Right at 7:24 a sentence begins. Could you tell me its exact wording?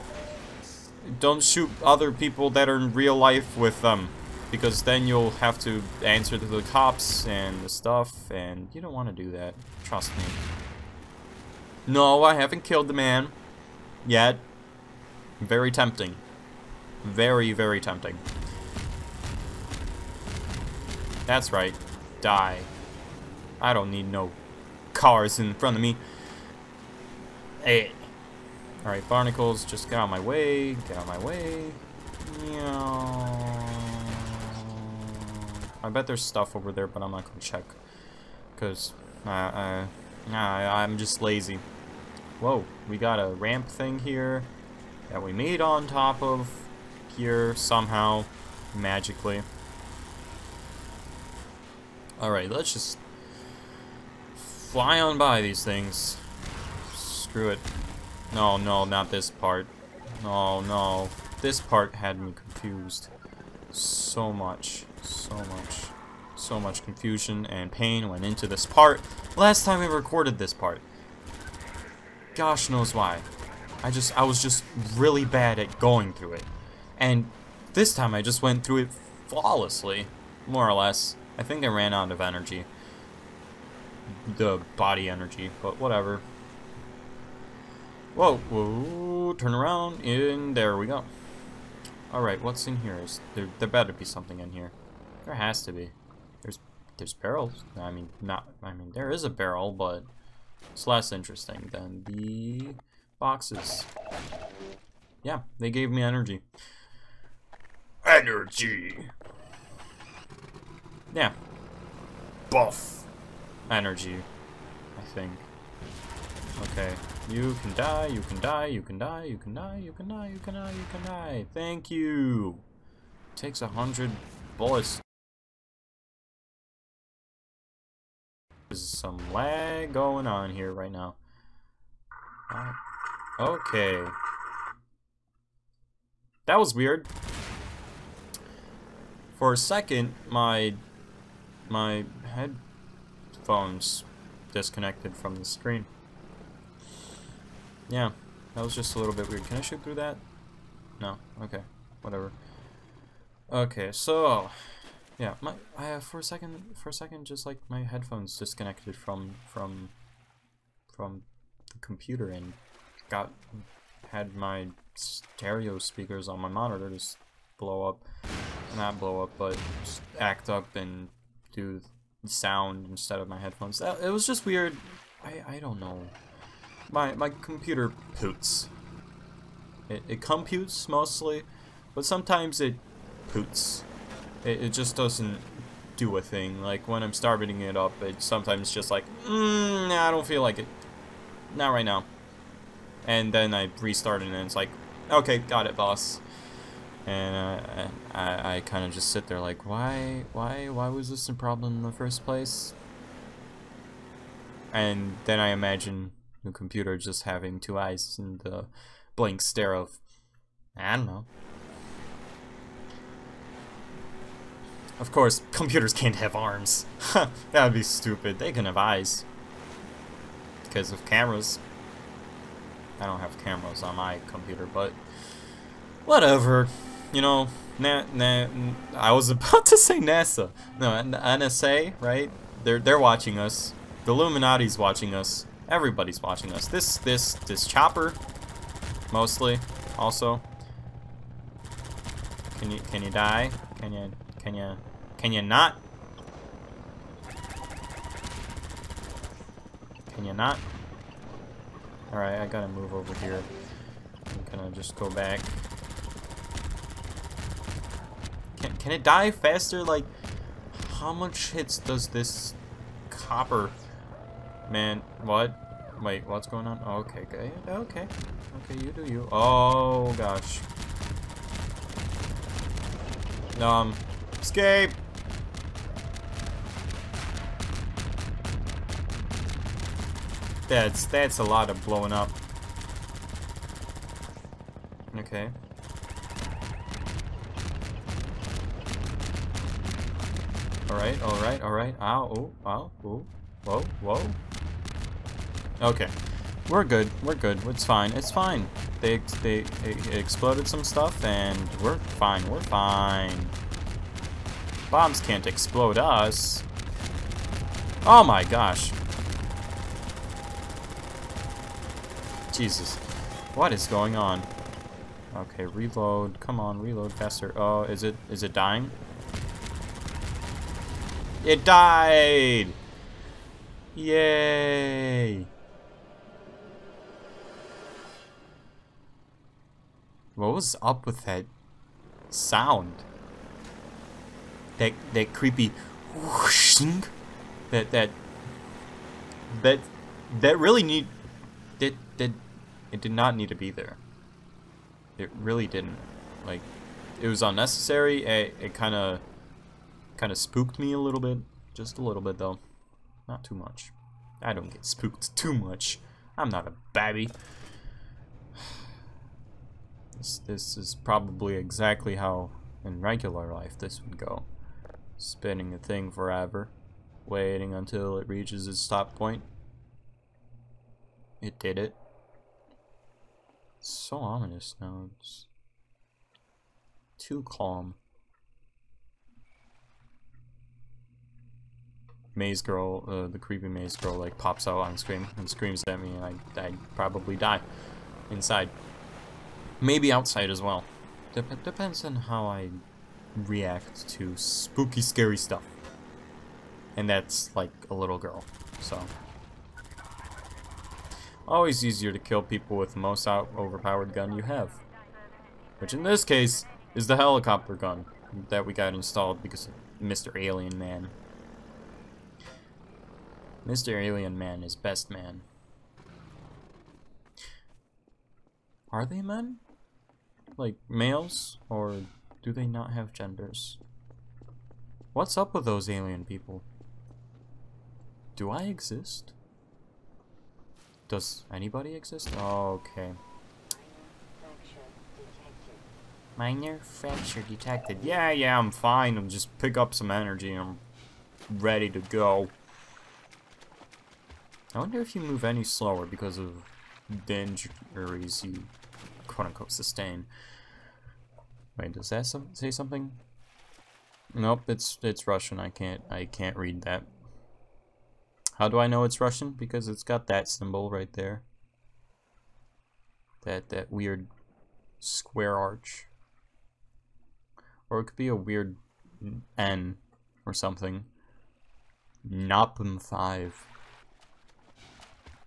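I wonder if you move any slower because of the injuries you quote-unquote sustain.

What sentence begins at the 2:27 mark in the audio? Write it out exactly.
Yeah, that was just a little bit weird.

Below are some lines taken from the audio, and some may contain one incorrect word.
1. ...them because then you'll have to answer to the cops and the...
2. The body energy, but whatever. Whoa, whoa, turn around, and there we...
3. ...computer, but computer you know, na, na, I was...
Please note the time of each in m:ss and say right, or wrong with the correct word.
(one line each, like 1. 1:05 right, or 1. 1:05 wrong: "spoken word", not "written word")
1. 0:03 right
2. 1:24 right
3. 3:44 wrong: "whatever", not "computer".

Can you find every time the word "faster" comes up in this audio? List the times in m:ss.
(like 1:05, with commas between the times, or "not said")
4:19, 5:17.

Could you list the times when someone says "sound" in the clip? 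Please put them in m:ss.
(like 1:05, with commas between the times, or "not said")
2:52, 5:32.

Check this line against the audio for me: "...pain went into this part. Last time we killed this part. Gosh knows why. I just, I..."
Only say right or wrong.
wrong.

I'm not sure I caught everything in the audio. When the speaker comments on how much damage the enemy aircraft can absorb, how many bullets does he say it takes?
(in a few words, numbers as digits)
100.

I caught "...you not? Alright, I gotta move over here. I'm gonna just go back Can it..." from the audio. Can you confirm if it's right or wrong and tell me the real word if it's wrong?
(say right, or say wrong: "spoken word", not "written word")
right.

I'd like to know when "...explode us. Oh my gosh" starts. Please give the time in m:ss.
5:05.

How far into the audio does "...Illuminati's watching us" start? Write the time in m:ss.
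3:54.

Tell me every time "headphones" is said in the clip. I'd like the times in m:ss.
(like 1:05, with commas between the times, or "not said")
2:23, 2:37, 2:53.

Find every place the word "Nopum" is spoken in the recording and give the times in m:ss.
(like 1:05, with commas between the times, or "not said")
7:52.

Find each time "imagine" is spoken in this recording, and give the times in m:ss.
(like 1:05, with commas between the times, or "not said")
3:25.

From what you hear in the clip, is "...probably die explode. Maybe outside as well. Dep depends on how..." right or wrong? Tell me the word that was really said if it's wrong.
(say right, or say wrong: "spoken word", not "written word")
wrong: "inside", not "explode".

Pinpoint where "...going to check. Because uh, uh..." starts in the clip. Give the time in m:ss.
0:37.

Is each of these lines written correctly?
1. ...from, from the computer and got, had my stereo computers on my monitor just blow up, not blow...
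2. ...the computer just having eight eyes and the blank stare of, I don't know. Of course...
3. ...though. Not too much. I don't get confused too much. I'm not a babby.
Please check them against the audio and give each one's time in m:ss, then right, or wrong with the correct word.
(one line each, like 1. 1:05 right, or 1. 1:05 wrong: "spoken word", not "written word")
1. 2:39 wrong: "speakers", not "computers"
2. 3:26 wrong: "two", not "eight"
3. 5:52 wrong: "spooked", not "confused".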